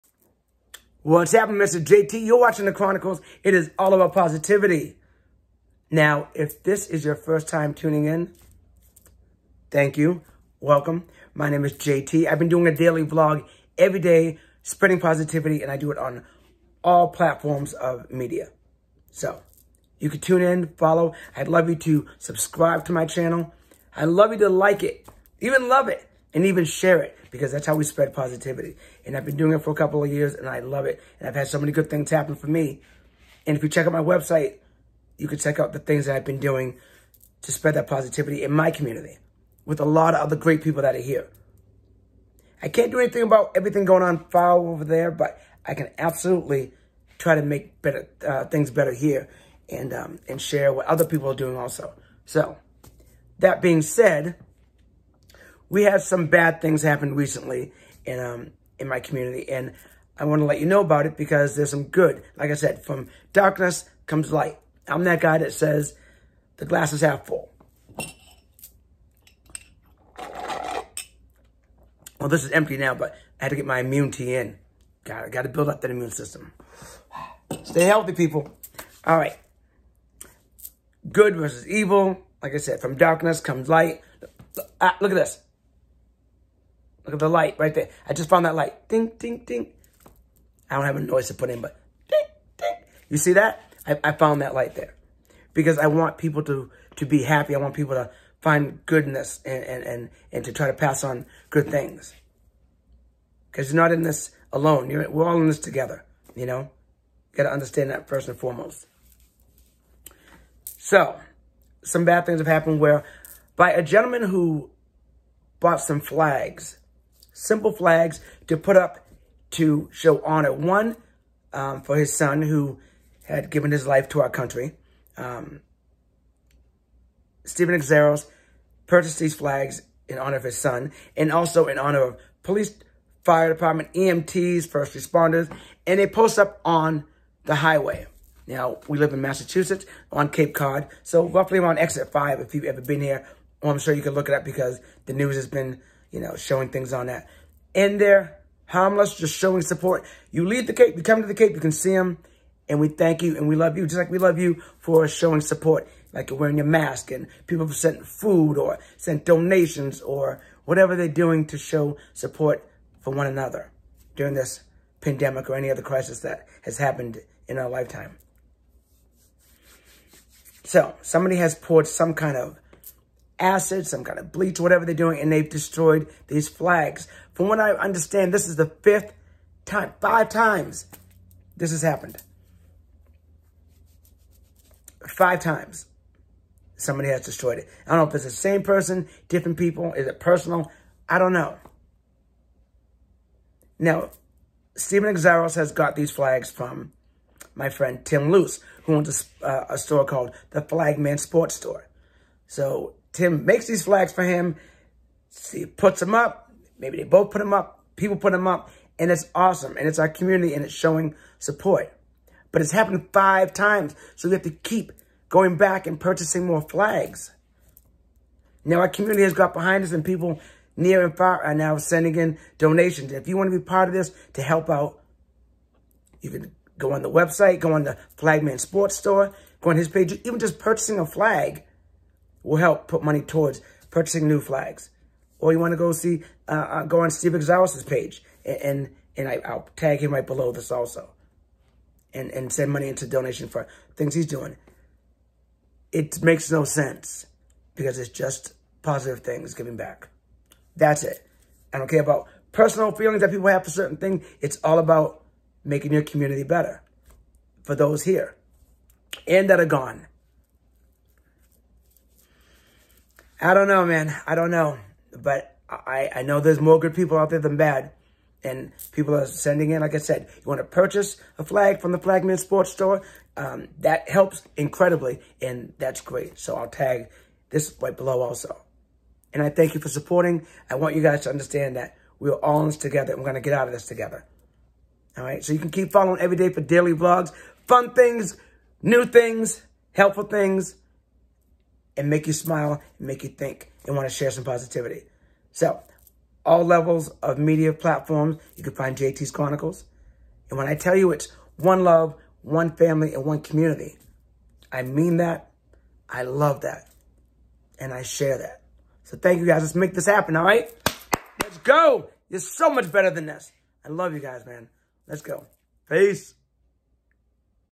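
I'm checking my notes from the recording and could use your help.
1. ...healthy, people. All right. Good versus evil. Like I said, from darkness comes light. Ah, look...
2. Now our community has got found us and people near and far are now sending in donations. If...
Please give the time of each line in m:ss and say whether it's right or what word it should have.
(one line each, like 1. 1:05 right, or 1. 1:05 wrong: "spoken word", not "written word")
1. 1:17 right
2. 3:38 wrong: "behind", not "found".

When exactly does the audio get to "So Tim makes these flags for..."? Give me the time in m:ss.
3:22.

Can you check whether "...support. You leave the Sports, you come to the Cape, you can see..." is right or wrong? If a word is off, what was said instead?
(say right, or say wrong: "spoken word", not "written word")
wrong: "Cape", not "Sports".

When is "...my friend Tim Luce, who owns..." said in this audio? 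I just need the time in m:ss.
3:17.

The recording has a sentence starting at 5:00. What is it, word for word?
And when I tell you it's one love, one family, and one community, I mean that.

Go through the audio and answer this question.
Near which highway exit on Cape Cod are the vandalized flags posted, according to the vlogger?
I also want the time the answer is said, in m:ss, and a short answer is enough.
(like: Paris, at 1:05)
exit 5, at 2:21.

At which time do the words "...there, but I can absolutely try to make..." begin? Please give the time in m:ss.
0:44.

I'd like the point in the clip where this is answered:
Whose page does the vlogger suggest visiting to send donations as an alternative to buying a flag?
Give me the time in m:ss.
3:57.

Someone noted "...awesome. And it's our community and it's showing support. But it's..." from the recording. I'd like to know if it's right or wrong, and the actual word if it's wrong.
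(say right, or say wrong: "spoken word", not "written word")
right.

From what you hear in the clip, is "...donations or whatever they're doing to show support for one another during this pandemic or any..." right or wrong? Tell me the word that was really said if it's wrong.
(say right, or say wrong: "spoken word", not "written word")
right.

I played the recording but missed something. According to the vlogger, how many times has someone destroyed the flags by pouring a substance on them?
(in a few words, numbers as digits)
5.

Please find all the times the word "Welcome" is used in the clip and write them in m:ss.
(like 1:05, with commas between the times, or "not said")
0:10.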